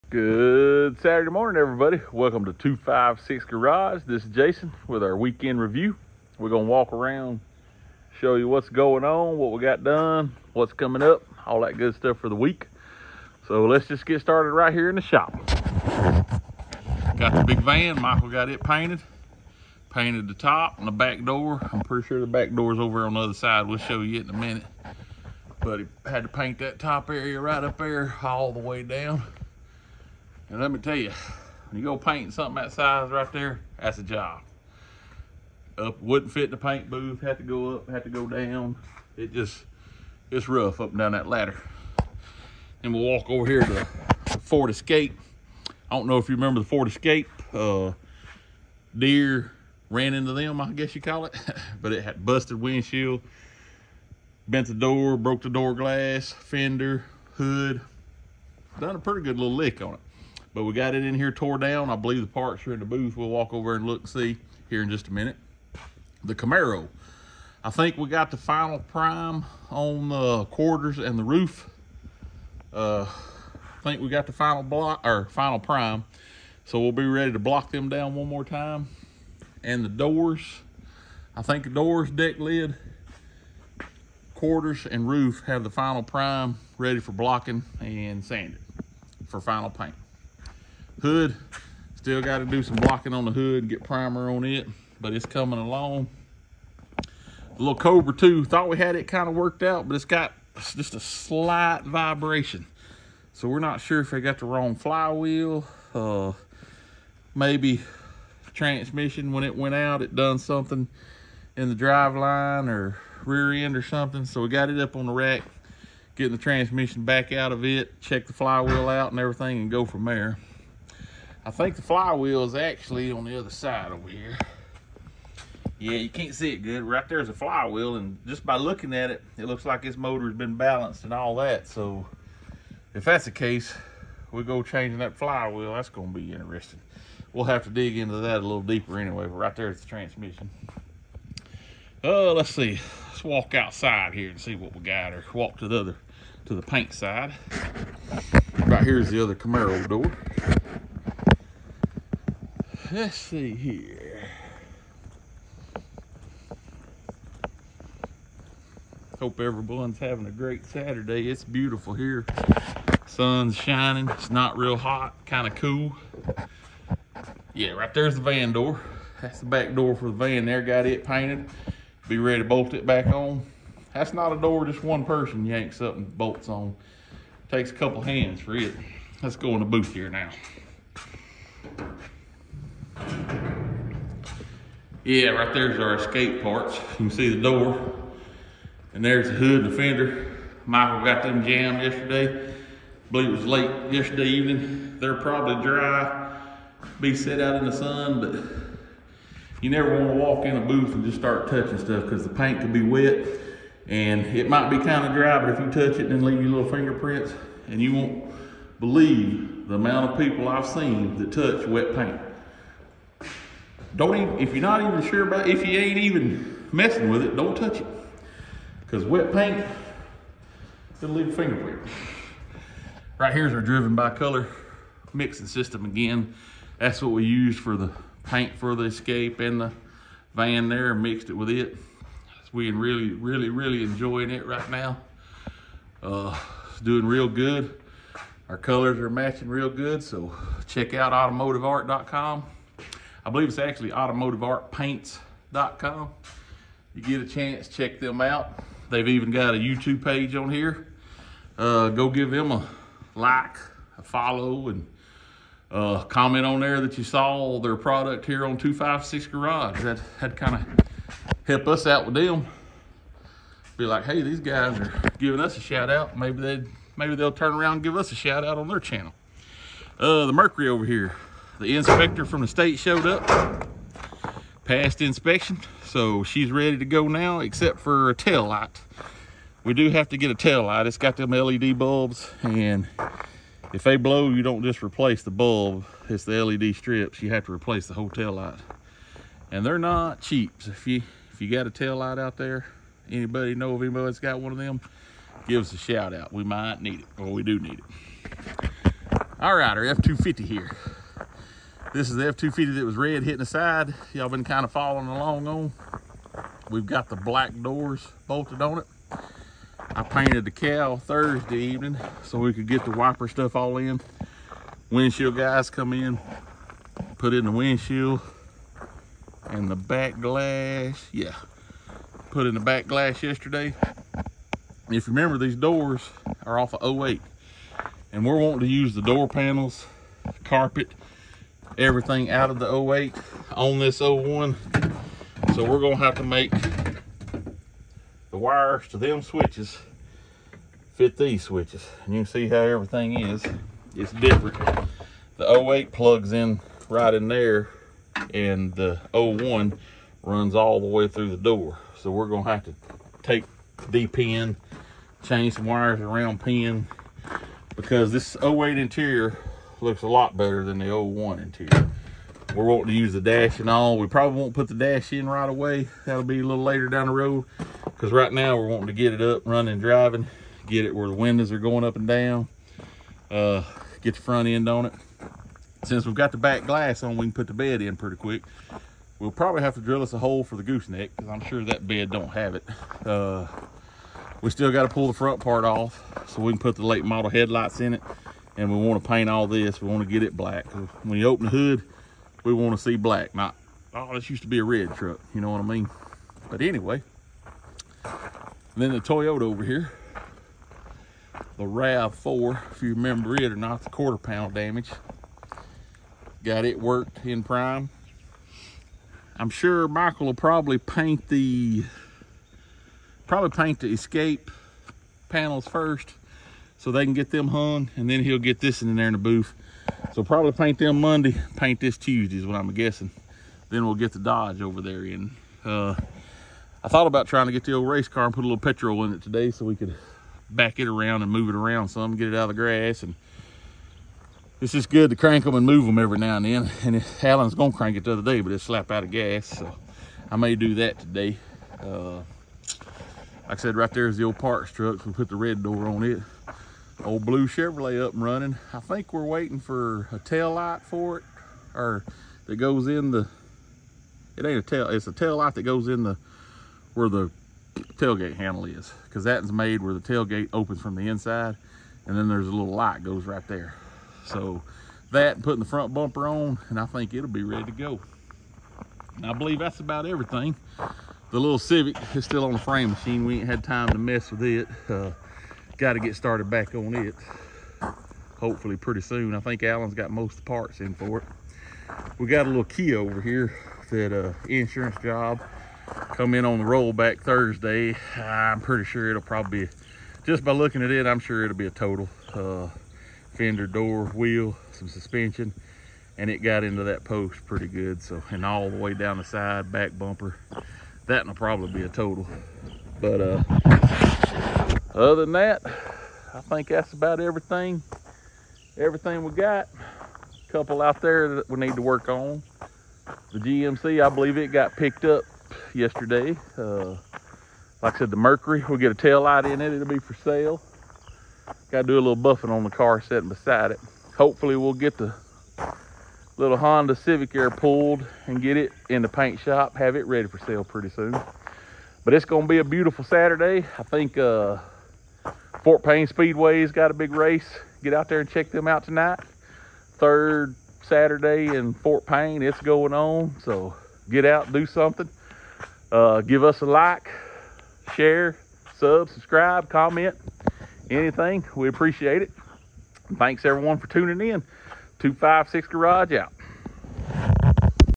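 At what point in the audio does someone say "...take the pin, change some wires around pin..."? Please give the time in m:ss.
5:53.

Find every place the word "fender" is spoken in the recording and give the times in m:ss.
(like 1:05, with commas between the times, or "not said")
0:56, 3:09, 8:13.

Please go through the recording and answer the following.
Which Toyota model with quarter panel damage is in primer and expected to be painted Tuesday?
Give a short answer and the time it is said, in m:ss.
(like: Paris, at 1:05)
RAV4, at 6:41.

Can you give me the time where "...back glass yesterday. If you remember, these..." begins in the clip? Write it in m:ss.
5:22.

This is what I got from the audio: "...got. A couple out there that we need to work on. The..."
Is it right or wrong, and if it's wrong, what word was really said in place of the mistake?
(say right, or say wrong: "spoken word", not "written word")
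right.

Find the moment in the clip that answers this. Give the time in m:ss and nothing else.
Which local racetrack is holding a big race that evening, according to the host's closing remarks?
8:55.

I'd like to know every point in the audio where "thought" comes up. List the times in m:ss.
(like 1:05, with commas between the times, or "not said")
1:38, 7:06.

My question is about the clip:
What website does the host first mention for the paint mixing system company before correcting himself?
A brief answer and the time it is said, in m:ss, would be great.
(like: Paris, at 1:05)
automotiveart.com, at 4:01.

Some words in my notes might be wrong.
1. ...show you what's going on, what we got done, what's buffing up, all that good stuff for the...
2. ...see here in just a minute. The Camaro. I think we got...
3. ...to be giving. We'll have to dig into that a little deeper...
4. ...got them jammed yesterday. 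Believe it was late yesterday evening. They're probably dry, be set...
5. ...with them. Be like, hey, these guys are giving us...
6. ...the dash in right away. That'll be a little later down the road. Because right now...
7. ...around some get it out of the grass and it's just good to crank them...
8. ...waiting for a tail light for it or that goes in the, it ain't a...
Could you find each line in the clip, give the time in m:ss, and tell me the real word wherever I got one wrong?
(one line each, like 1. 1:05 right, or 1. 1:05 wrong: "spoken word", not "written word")
1. 0:08 wrong: "coming", not "buffing"
2. 1:04 right
3. 2:16 wrong: "interesting", not "giving"
4. 3:11 right
5. 4:22 right
6. 6:04 right
7. 7:11 right
8. 7:29 right.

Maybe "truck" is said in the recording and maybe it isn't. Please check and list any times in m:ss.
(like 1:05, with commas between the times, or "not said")
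6:34, 7:24.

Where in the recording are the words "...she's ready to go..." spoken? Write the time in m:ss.
4:36.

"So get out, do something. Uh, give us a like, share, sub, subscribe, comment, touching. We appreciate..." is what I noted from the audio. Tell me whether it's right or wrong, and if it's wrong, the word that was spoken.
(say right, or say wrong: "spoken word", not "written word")
wrong: "anything", not "touching".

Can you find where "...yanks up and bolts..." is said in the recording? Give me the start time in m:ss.
2:55.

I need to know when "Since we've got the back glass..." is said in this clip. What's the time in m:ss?
6:15.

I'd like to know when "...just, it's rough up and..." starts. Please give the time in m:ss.
0:39.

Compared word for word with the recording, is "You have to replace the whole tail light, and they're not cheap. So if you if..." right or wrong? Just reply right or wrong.
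right.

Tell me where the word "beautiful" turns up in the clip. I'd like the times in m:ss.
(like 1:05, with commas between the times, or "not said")
2:41, 8:52.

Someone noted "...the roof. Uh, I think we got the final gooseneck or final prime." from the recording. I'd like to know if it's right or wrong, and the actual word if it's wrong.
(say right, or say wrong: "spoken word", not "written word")
wrong: "block", not "gooseneck".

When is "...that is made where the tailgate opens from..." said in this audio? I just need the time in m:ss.
7:39.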